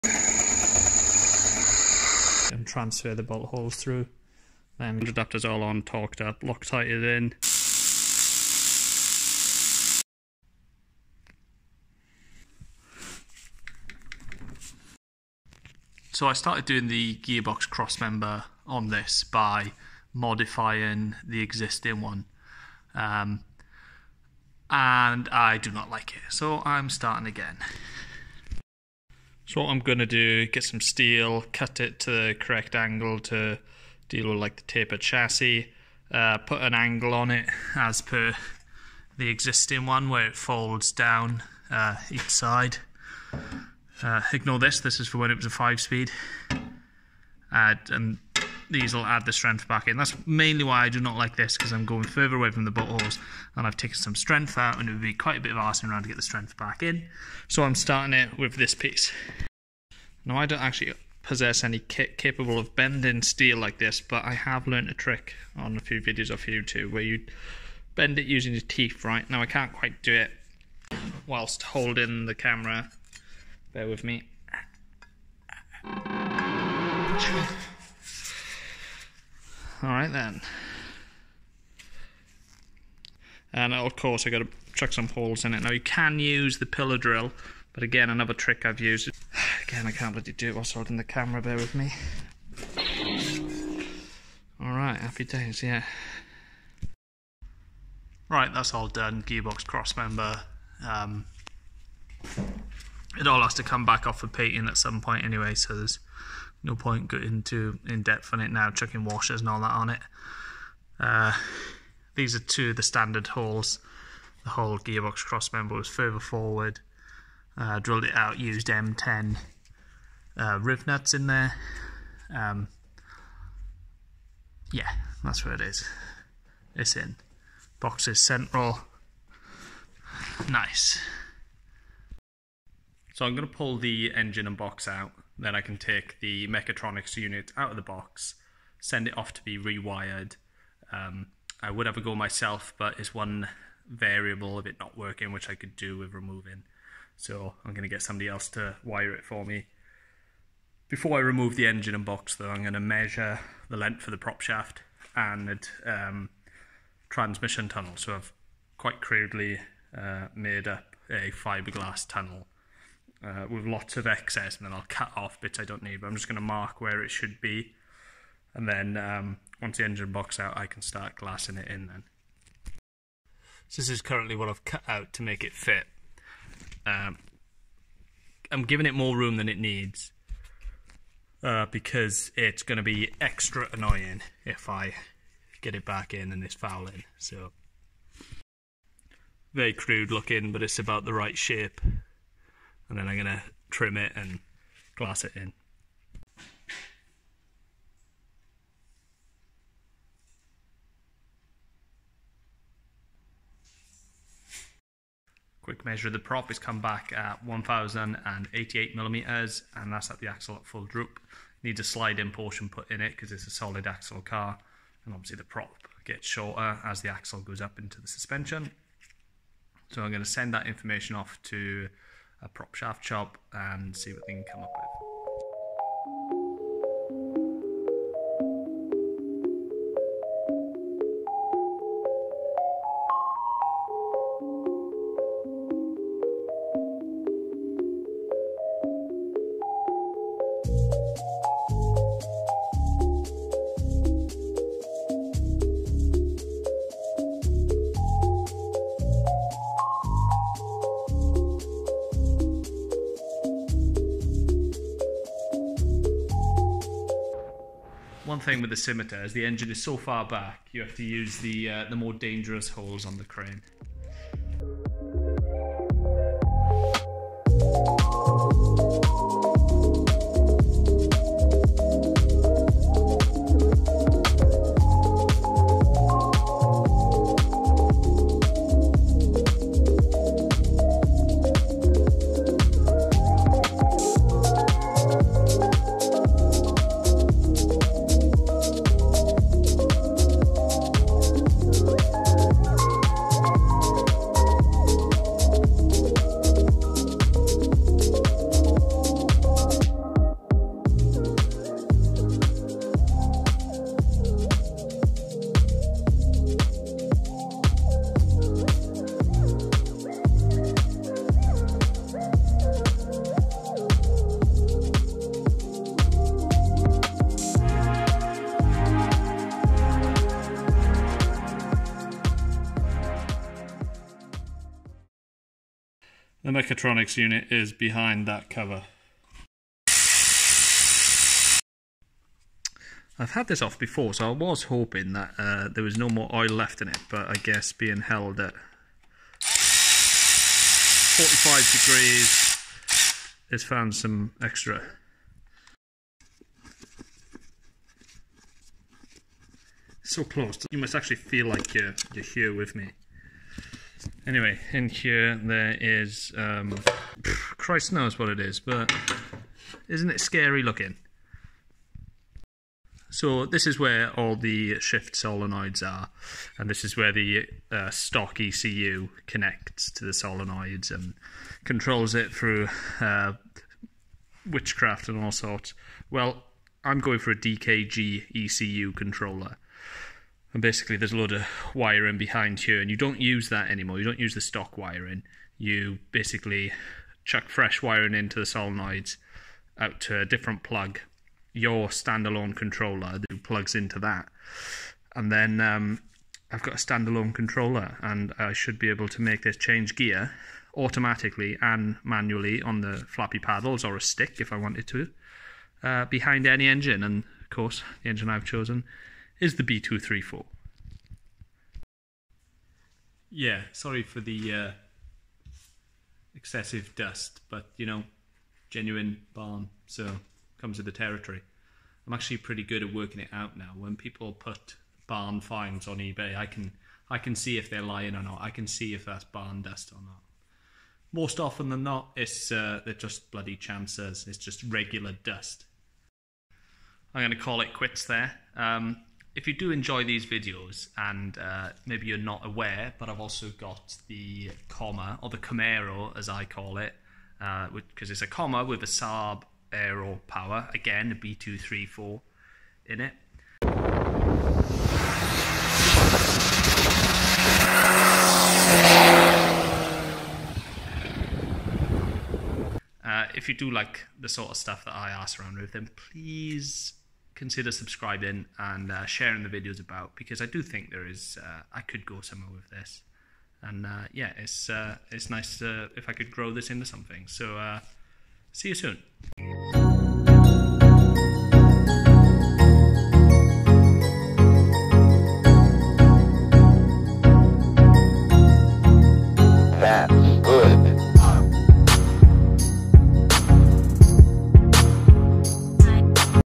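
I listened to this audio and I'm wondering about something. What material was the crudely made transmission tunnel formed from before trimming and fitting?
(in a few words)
Fiberglass.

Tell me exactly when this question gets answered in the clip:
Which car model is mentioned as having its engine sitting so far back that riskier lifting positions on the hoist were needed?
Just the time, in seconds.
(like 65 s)
258 s.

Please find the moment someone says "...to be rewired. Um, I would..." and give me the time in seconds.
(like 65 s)
139 s.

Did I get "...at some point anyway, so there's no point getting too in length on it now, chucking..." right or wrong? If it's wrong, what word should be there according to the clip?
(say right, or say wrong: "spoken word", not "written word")
wrong: "depth", not "length".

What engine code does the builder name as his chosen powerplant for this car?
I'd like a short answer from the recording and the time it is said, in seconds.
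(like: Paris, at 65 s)
B234, at 409 s.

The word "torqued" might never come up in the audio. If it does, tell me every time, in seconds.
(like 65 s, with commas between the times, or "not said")
5 s.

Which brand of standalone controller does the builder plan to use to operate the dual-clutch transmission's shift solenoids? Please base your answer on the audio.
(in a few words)
DKG.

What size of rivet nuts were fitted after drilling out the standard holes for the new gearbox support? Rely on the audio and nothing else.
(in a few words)
M10.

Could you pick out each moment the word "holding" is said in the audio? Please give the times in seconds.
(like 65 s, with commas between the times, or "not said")
71 s, 90 s.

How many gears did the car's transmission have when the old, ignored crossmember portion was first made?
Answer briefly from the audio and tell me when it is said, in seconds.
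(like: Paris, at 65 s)
5, at 45 s.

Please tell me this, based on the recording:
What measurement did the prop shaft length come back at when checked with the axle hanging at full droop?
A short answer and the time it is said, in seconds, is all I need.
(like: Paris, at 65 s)
1088 millimeters, at 207 s.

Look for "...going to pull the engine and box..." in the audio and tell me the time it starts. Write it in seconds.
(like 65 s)
133 s.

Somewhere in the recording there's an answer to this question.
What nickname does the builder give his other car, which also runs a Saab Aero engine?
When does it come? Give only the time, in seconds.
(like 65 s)
445 s.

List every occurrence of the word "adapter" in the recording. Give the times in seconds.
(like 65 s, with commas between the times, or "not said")
5 s.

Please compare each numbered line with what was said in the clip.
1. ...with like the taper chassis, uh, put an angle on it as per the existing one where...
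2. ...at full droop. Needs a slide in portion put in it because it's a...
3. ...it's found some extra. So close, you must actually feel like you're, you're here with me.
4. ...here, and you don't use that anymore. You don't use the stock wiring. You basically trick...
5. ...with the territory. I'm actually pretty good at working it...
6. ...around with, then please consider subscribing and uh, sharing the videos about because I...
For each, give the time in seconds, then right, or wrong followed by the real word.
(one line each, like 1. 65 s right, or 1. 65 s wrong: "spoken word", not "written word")
1. 34 s right
2. 210 s right
3. 343 s right
4. 382 s wrong: "chuck", not "trick"
5. 420 s right
6. 465 s right.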